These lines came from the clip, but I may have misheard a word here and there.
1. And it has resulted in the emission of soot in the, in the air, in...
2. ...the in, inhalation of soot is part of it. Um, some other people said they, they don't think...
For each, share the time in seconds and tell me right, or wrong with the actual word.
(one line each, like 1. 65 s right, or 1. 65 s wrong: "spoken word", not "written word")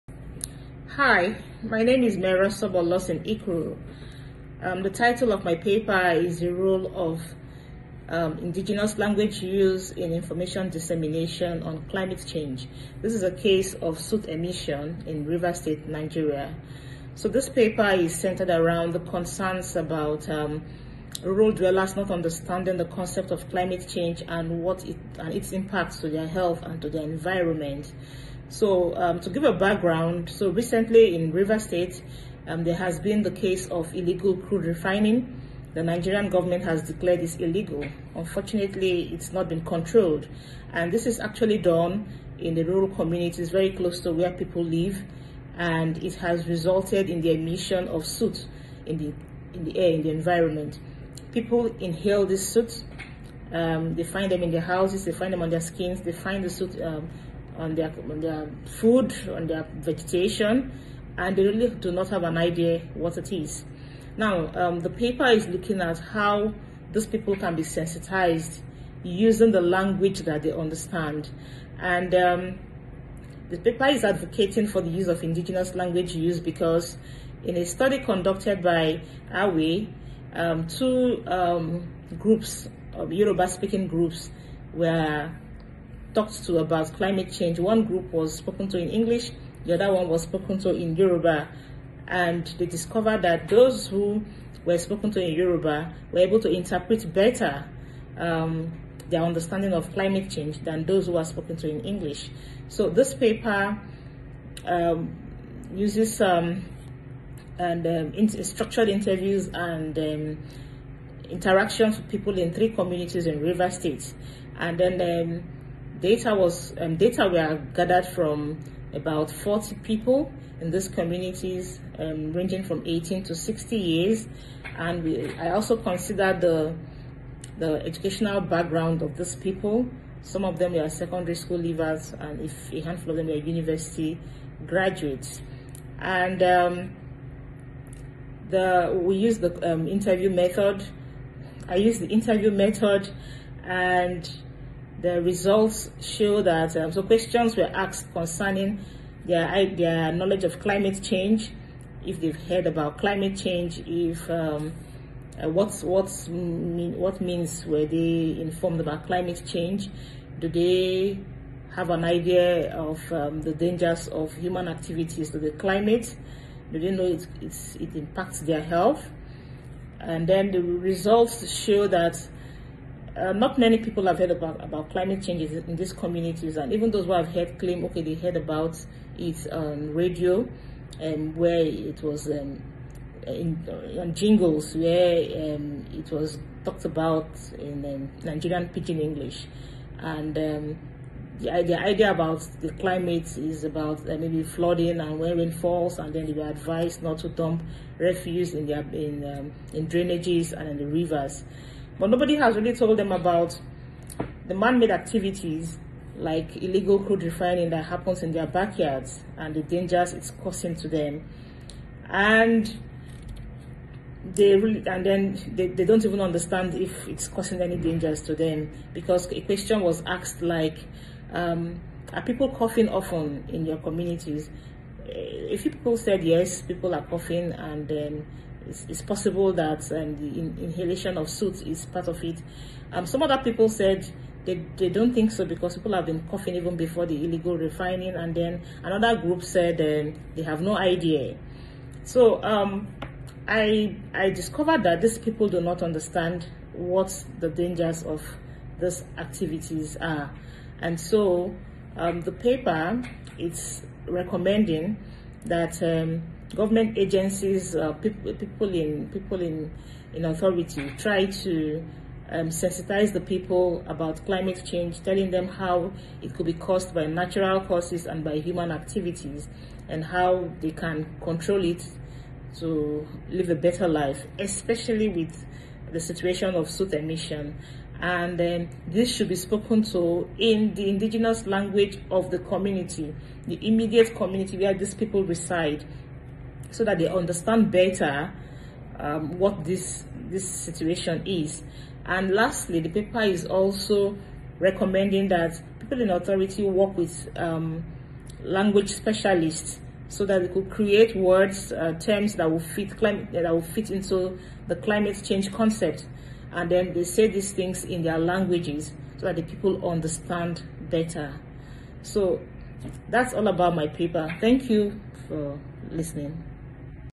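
1. 45 s right
2. 230 s right.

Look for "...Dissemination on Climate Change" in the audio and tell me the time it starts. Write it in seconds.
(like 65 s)
10 s.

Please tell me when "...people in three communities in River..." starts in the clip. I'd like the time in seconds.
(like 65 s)
112 s.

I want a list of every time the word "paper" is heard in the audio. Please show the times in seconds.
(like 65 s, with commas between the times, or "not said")
5 s, 17 s, 64 s, 73 s, 103 s, 252 s, 292 s, 313 s.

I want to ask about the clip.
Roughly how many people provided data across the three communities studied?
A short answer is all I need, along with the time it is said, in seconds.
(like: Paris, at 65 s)
40, at 119 s.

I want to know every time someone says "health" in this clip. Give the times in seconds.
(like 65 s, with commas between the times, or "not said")
26 s, 168 s.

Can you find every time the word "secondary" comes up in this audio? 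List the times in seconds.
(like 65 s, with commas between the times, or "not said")
130 s.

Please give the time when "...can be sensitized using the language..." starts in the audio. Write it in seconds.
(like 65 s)
67 s.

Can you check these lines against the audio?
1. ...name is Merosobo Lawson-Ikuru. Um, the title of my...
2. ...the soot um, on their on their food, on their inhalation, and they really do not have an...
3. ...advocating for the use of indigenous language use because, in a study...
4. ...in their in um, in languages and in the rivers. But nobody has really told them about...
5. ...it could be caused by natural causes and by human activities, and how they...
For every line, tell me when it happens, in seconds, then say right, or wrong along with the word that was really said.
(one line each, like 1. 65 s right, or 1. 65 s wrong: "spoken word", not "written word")
1. 1 s right
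2. 56 s wrong: "vegetation", not "inhalation"
3. 74 s right
4. 198 s wrong: "drainages", not "languages"
5. 266 s right.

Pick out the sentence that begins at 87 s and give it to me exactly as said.
One group was spoken to in English, the other one was spoken to in Yoruba.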